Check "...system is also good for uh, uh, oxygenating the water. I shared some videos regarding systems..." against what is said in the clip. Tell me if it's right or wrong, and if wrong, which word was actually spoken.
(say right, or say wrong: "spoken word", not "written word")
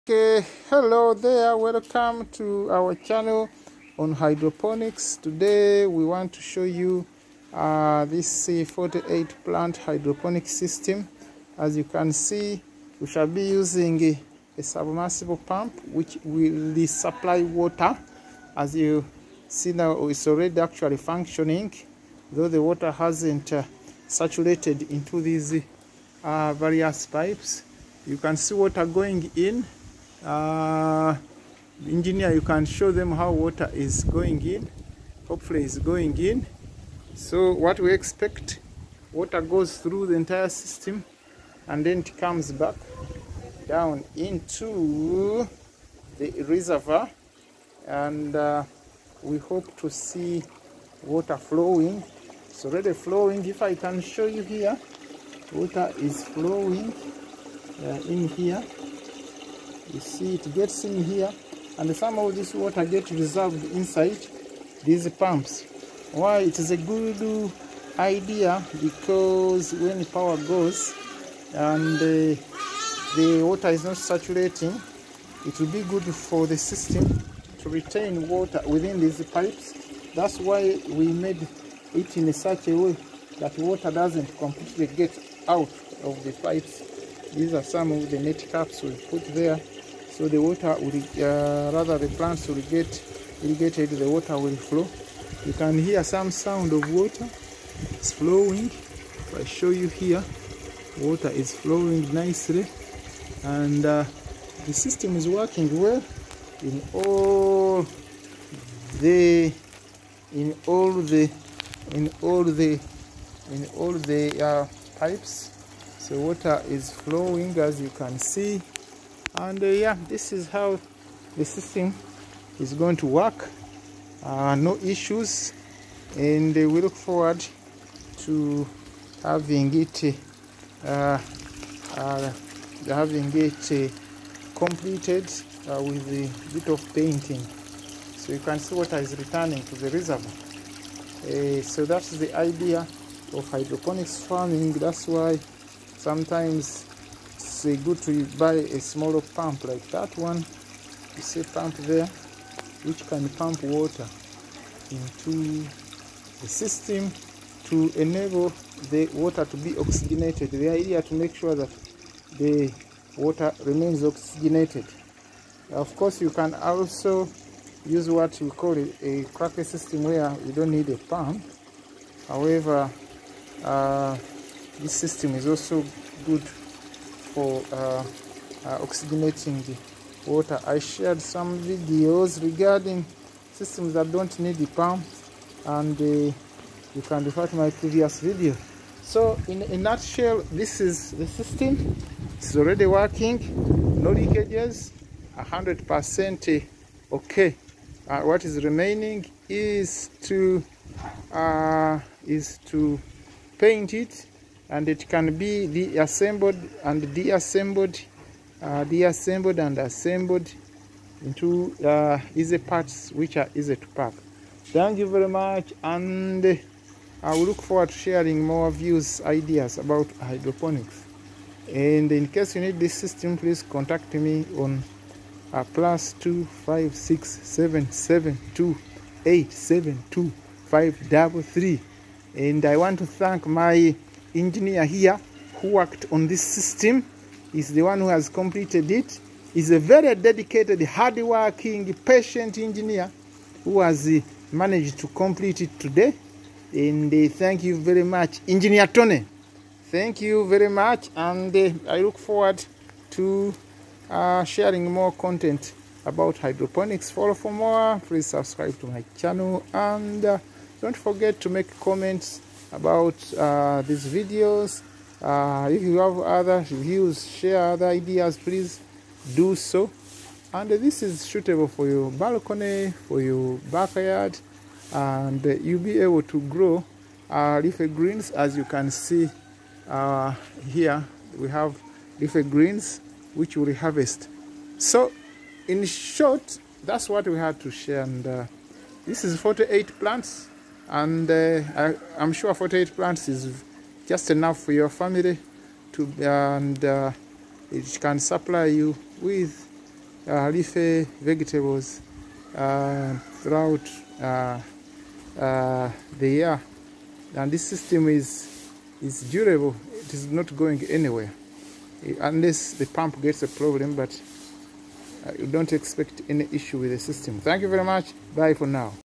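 right.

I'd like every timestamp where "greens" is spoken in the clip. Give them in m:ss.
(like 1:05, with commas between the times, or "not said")
4:37, 4:42.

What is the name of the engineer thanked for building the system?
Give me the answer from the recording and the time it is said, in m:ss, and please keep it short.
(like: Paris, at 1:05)
Tony, at 4:08.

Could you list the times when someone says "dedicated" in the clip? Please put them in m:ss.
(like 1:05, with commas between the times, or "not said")
4:00.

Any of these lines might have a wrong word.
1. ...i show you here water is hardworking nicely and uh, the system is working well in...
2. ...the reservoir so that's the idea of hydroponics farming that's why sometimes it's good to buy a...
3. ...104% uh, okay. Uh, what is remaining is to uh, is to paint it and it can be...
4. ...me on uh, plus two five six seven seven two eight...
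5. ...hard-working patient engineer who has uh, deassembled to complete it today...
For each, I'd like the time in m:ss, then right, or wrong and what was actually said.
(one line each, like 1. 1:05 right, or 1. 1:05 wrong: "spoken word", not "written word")
1. 1:39 wrong: "flowing", not "hardworking"
2. 2:19 right
3. 3:15 wrong: "100", not "104"
4. 3:44 right
5. 4:00 wrong: "managed", not "deassembled".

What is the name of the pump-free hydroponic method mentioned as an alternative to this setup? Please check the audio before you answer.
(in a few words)
Kratky system.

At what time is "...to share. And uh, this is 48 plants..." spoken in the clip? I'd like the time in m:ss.
4:47.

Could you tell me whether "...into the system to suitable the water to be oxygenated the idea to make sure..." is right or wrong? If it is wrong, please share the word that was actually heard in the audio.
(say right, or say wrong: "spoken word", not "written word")
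wrong: "enable", not "suitable".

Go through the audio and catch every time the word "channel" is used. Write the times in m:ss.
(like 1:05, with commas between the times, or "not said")
0:02, 4:19.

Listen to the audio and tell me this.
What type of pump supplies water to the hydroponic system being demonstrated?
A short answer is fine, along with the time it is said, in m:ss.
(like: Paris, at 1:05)
Submersible pump, at 0:14.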